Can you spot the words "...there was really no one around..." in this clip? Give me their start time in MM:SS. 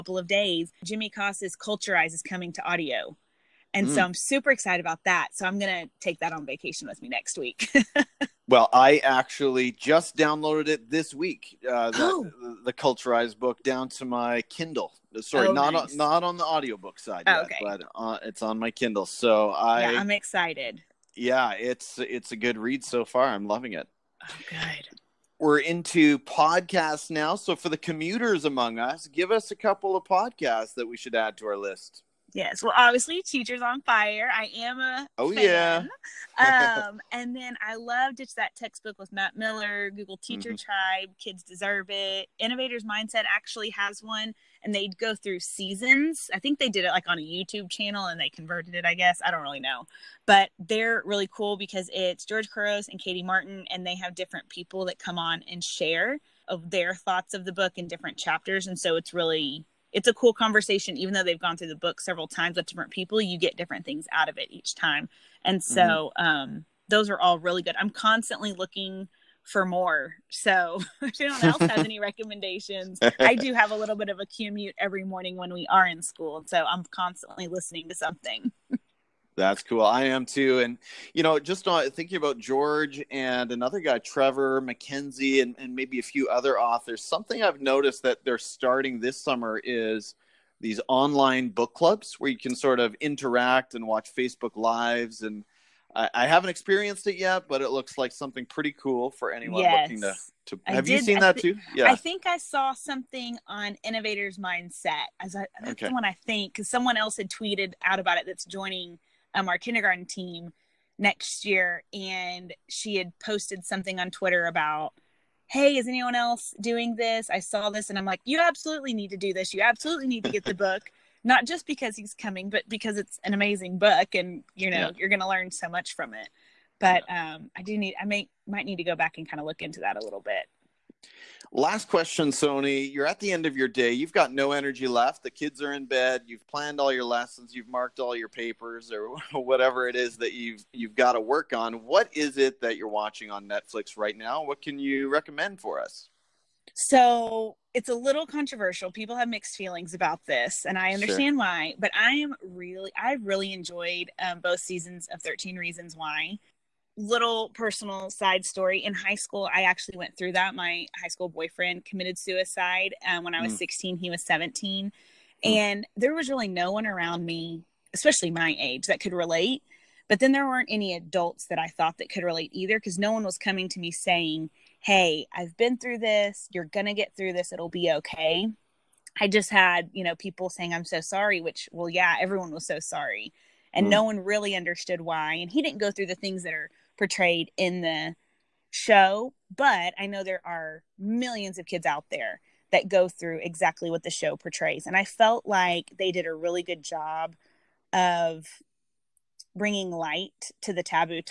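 02:45.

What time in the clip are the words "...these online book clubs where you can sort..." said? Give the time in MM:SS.
01:30.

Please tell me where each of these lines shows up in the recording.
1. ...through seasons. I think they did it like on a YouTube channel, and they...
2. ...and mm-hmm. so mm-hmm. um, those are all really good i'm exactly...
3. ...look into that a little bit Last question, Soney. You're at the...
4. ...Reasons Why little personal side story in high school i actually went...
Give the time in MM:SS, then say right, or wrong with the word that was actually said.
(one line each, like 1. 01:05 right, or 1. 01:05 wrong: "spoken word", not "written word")
1. 00:45 right
2. 01:05 wrong: "constantly", not "exactly"
3. 02:09 right
4. 02:35 right.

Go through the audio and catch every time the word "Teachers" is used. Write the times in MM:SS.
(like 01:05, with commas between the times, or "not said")
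00:33, 00:40.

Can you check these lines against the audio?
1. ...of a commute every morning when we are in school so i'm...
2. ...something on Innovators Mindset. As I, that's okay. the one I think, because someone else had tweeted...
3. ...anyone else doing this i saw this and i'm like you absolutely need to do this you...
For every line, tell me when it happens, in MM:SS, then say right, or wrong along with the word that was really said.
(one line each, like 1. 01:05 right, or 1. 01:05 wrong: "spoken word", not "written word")
1. 01:14 right
2. 01:42 right
3. 01:55 right.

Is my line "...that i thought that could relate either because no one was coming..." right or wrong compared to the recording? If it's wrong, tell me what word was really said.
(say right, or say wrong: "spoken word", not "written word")
right.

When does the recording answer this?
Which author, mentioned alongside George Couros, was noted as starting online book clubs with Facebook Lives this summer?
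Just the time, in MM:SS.
01:23.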